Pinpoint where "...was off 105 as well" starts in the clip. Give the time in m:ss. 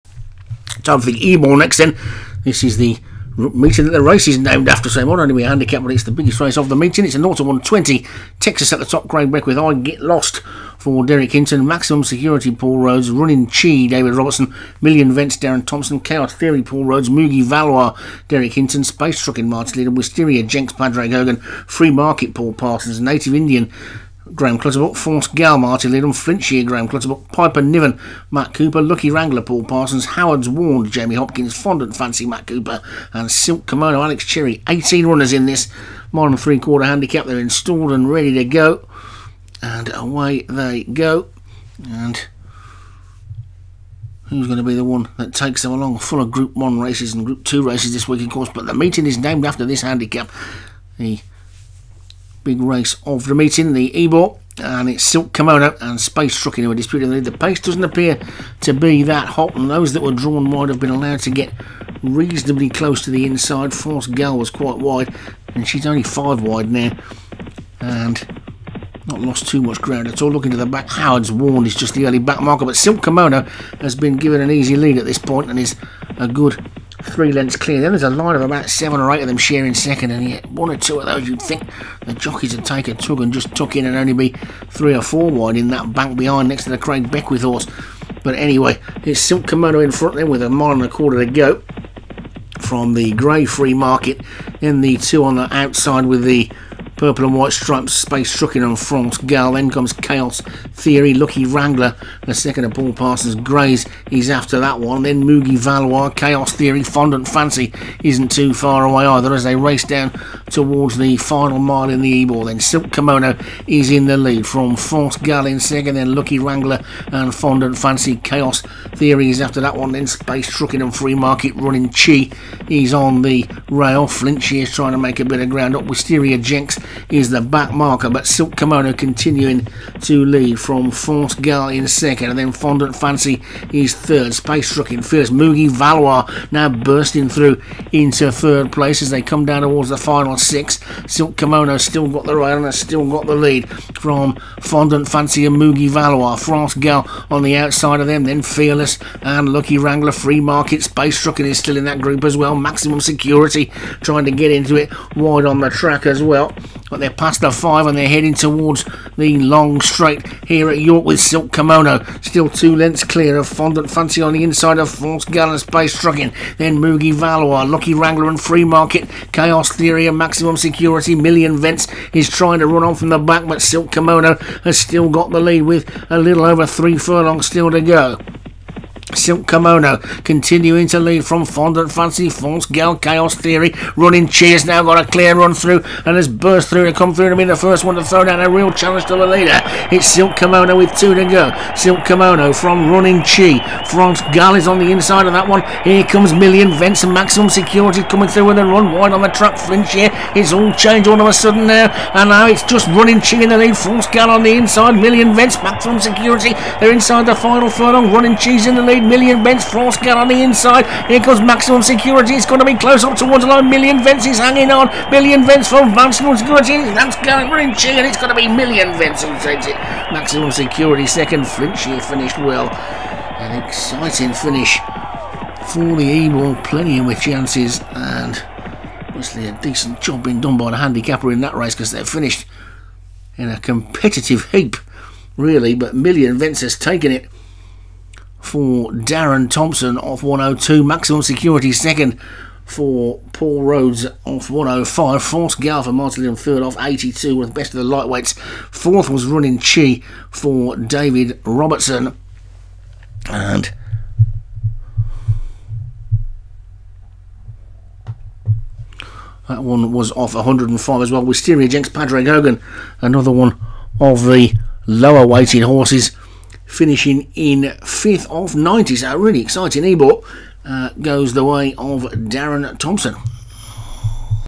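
4:19.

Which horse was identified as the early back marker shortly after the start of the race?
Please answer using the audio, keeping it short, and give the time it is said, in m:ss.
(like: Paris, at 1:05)
Howard's Ward, at 1:10.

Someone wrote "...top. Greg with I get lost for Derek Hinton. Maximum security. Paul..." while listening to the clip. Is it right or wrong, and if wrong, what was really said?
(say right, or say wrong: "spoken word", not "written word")
right.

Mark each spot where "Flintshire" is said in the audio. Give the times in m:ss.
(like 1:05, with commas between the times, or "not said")
0:26, 2:04, 3:41.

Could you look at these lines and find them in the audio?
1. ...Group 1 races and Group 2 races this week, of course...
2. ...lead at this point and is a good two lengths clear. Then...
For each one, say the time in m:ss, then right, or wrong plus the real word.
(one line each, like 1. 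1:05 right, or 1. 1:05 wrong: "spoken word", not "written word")
1. 0:46 right
2. 1:14 wrong: "three", not "two".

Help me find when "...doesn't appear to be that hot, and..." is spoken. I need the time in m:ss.
0:57.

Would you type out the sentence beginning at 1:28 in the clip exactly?
But anyway, it's Silk Kimono in front then, with a mile and a quarter to go from the grey free market.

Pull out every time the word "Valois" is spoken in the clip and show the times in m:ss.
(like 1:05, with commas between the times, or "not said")
0:17, 1:45, 2:15, 2:25, 2:47.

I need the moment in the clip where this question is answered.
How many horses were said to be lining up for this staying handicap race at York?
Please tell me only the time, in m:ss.
0:34.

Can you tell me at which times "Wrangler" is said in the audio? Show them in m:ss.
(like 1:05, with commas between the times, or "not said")
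0:29, 1:41, 1:56, 2:29, 2:47.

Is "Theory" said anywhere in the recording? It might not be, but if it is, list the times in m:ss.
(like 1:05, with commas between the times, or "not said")
0:16, 1:40, 1:46, 1:58, 2:49, 3:03.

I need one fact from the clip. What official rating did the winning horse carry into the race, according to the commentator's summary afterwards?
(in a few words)
102.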